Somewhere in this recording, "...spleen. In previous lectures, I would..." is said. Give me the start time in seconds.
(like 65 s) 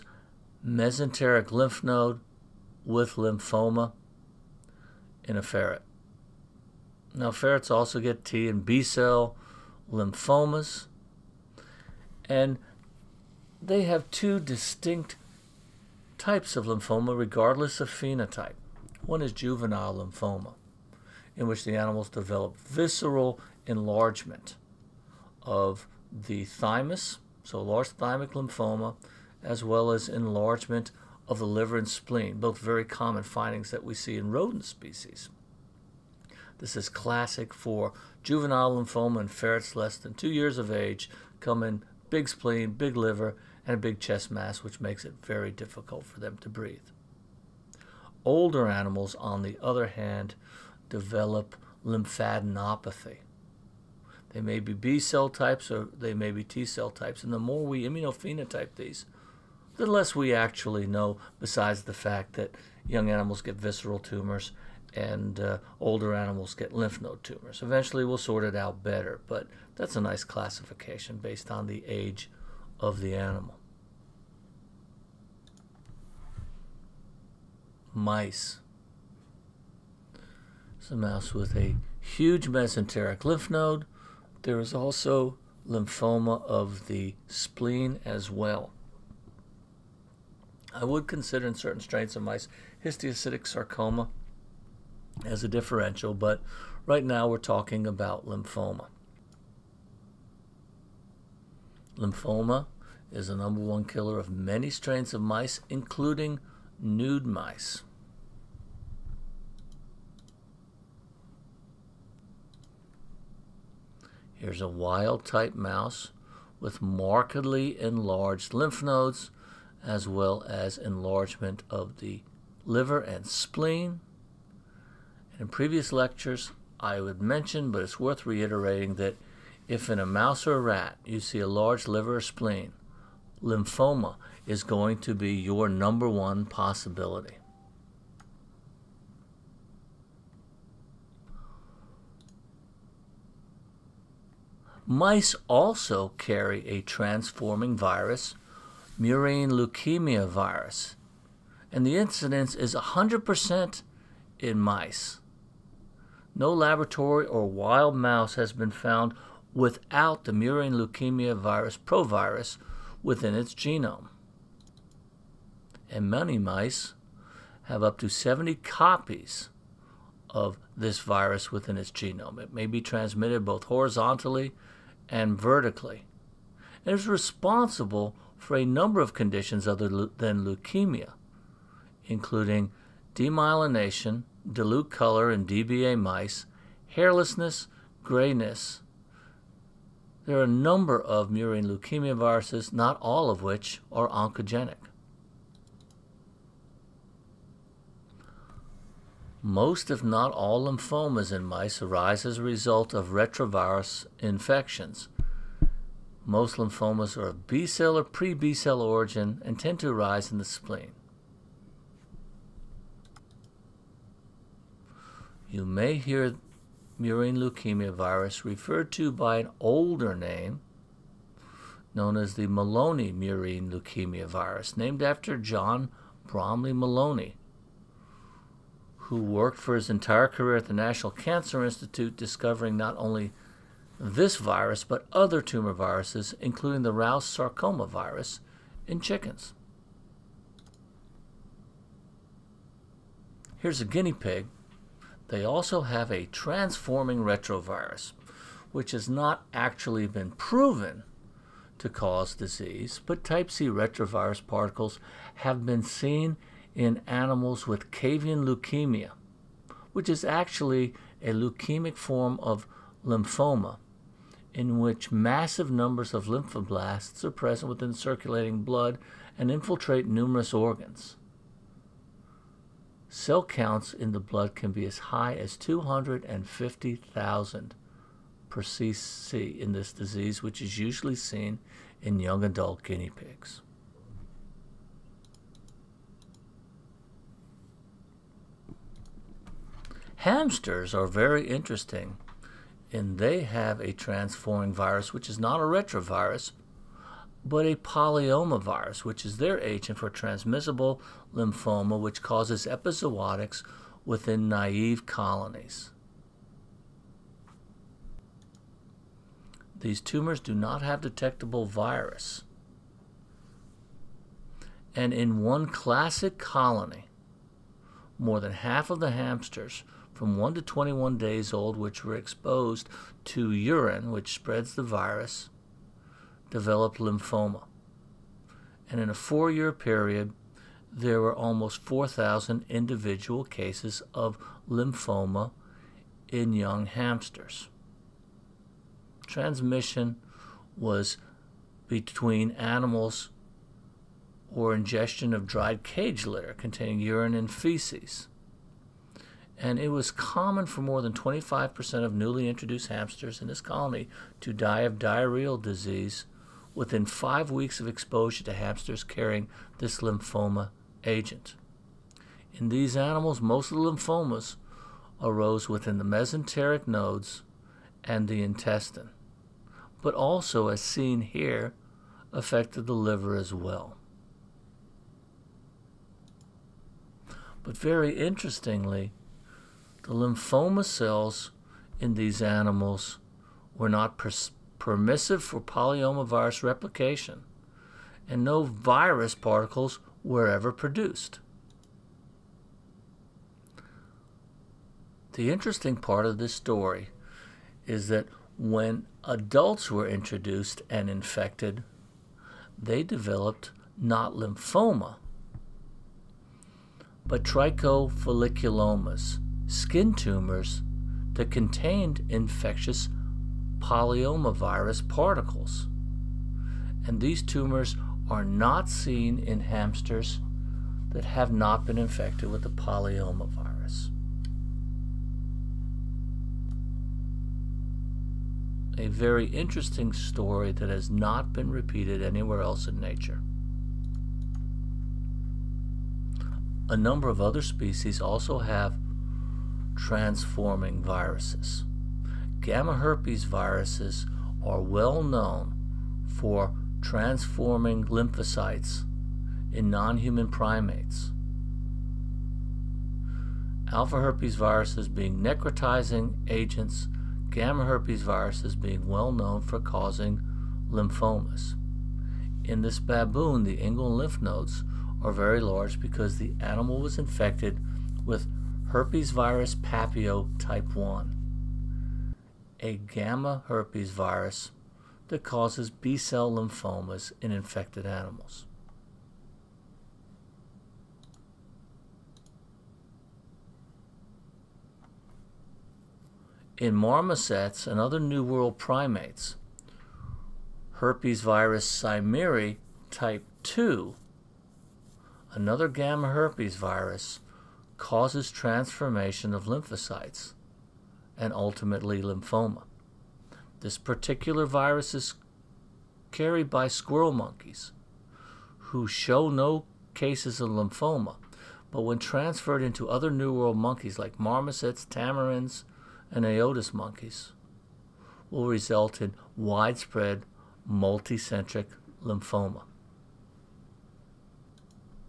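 123 s.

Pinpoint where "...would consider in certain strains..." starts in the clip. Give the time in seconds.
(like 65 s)
90 s.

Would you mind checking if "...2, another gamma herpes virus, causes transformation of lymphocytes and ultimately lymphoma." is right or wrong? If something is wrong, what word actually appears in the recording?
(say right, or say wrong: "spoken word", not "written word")
right.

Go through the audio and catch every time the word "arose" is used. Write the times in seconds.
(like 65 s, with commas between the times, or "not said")
365 s.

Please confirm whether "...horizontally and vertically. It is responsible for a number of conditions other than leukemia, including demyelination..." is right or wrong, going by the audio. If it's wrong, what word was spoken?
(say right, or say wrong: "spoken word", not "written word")
right.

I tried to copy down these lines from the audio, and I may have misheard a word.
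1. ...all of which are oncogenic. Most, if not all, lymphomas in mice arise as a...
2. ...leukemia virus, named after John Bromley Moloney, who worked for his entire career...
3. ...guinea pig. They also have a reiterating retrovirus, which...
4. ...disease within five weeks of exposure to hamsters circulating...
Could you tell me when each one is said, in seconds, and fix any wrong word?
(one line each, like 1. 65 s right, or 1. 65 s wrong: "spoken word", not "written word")
1. 192 s right
2. 223 s right
3. 243 s wrong: "transforming", not "reiterating"
4. 355 s wrong: "carrying", not "circulating".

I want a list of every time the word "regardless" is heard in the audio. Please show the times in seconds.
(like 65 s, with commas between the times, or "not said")
17 s.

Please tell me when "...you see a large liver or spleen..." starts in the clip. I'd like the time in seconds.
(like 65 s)
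131 s.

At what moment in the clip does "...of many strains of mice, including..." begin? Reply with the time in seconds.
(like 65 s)
104 s.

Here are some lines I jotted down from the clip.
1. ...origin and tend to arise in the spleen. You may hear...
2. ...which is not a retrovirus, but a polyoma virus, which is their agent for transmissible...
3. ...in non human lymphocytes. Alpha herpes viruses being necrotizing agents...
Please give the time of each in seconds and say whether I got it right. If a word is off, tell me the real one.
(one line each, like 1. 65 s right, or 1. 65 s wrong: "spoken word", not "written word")
1. 208 s right
2. 295 s right
3. 449 s wrong: "primates", not "lymphocytes".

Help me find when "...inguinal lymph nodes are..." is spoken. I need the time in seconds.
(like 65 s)
463 s.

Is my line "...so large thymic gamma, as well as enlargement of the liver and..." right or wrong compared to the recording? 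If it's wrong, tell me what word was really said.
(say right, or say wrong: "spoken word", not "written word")
wrong: "lymphoma", not "gamma".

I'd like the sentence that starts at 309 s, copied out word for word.
These tumors do not have detectable virus.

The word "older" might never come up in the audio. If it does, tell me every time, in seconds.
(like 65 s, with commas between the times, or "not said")
48 s, 65 s, 219 s.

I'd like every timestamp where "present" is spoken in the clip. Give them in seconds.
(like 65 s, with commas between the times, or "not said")
267 s.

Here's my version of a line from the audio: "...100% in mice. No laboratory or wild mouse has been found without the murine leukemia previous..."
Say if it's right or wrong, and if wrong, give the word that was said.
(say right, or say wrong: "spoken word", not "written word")
wrong: "virus", not "previous".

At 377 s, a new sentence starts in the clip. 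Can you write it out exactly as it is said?
But very interestingly, the lymphoma cells in these animals were not permissive for polyomavirus replication, and no virus particles were ever produced.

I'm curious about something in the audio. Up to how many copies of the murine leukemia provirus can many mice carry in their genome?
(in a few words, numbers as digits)
70.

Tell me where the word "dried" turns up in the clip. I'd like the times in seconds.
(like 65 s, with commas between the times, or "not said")
345 s.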